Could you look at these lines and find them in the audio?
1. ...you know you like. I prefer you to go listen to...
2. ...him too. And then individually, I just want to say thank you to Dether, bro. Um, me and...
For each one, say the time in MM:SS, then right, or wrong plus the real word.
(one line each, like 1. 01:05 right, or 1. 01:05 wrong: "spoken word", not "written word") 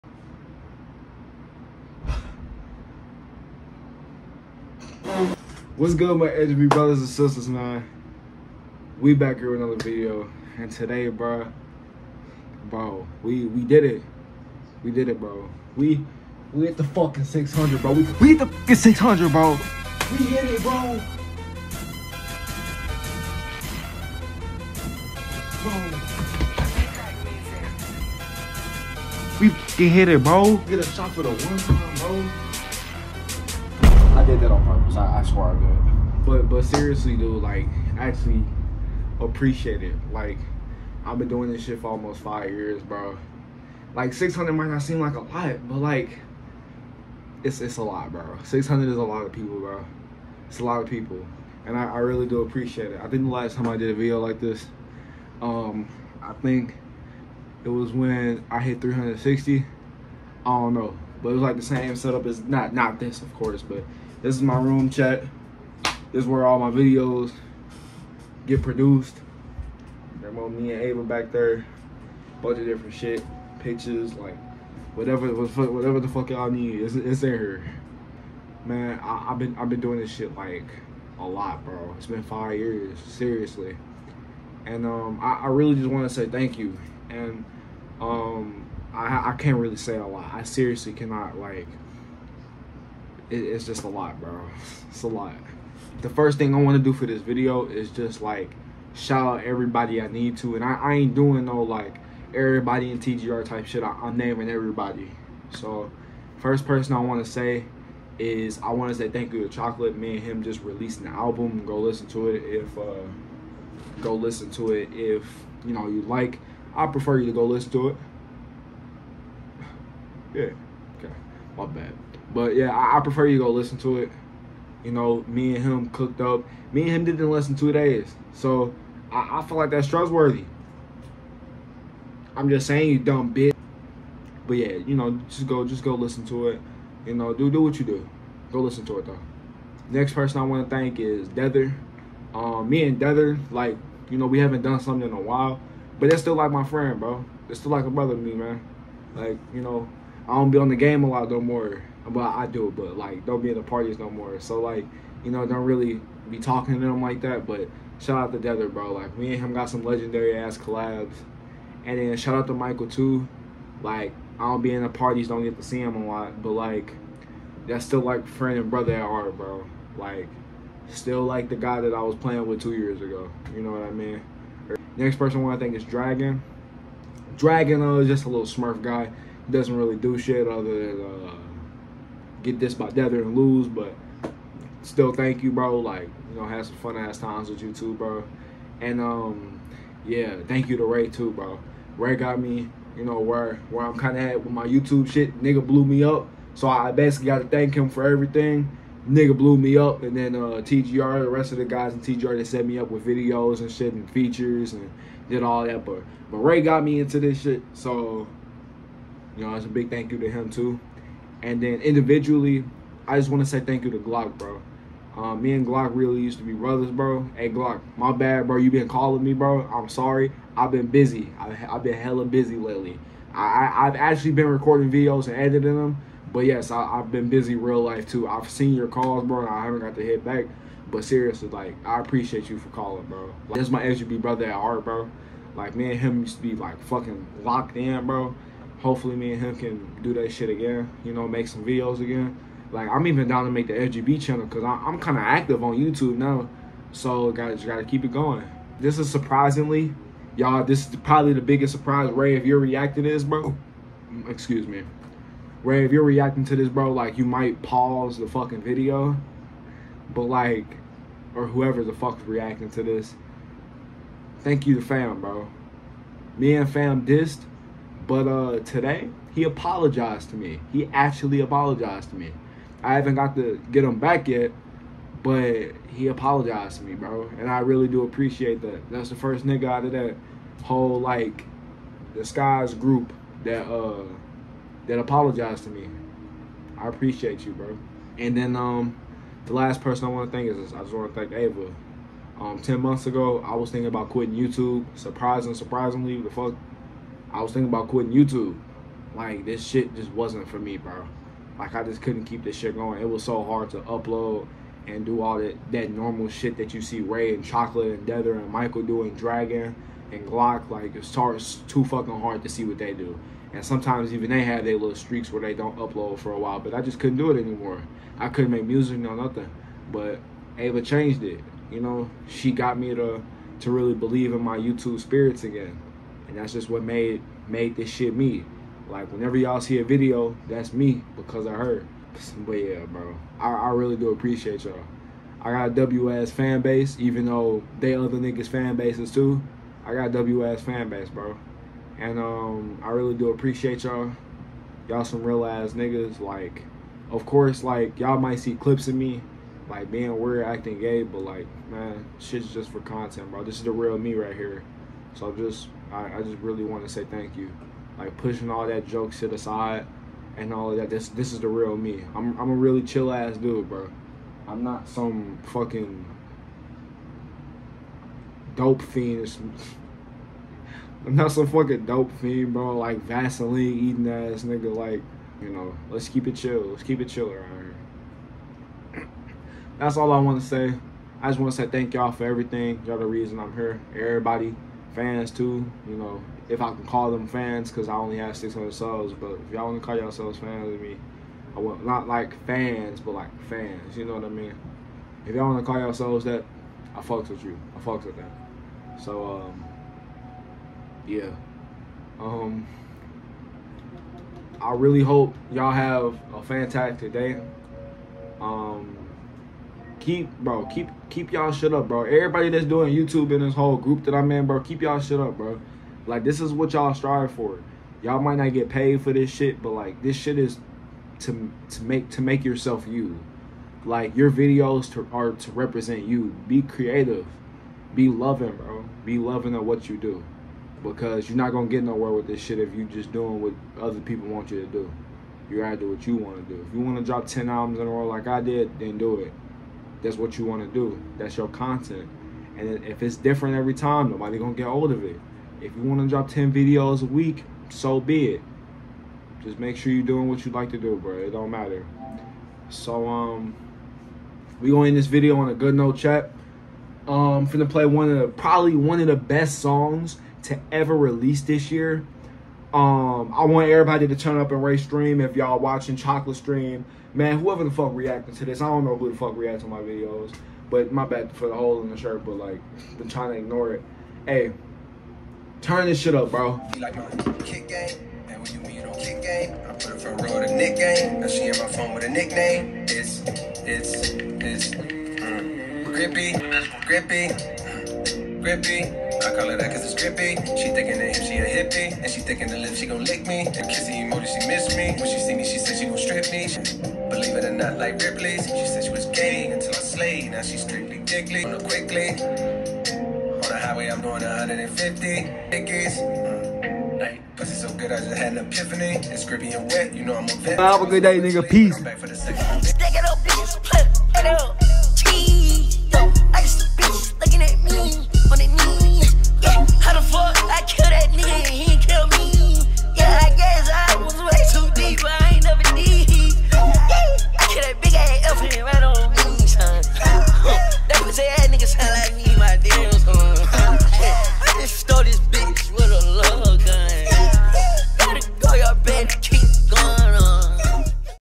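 1. 01:55 right
2. 03:30 wrong: "Glock", not "Dether".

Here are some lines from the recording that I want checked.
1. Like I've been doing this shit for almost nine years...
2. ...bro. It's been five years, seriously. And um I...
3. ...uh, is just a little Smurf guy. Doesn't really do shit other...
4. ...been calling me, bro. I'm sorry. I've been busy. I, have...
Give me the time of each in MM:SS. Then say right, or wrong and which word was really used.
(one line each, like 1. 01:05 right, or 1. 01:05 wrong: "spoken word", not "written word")
1. 00:40 wrong: "five", not "nine"
2. 01:21 right
3. 02:57 right
4. 03:38 right.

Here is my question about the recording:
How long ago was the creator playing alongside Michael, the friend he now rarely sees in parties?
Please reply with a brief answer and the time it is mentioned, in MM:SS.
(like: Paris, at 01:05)
2 years, at 02:52.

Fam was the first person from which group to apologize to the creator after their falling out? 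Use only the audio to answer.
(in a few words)
Skies.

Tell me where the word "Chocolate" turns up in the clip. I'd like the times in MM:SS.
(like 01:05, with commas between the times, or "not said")
01:49, 05:07, 07:45.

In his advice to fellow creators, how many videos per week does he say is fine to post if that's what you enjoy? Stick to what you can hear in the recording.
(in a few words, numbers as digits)
10.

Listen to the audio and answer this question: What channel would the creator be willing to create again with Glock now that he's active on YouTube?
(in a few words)
LGB channel.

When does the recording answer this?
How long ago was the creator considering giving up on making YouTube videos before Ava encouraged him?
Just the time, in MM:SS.
04:52.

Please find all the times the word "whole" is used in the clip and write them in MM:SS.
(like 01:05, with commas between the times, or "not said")
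04:40, 06:53.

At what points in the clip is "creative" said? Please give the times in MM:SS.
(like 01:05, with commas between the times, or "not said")
07:06.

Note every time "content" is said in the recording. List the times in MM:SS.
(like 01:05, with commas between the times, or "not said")
05:52, 07:21.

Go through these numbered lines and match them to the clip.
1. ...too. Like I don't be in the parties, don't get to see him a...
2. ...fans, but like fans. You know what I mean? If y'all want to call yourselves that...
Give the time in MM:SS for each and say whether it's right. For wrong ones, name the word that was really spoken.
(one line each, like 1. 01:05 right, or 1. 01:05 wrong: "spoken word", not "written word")
1. 02:42 right
2. 06:32 right.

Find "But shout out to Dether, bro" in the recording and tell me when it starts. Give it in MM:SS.
02:37.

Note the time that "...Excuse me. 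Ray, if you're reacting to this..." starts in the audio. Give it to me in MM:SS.
04:14.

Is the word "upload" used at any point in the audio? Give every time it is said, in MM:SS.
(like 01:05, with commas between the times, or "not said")
05:03, 05:15.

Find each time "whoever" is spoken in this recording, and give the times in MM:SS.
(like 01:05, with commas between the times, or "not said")
04:21, 07:47.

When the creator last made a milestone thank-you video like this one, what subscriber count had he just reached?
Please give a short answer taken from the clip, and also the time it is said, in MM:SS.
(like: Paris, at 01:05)
360, at 00:58.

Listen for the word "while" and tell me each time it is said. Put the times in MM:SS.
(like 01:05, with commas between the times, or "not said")
02:25, 05:16.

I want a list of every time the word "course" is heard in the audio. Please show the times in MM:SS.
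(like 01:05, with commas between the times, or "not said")
01:03, 05:47.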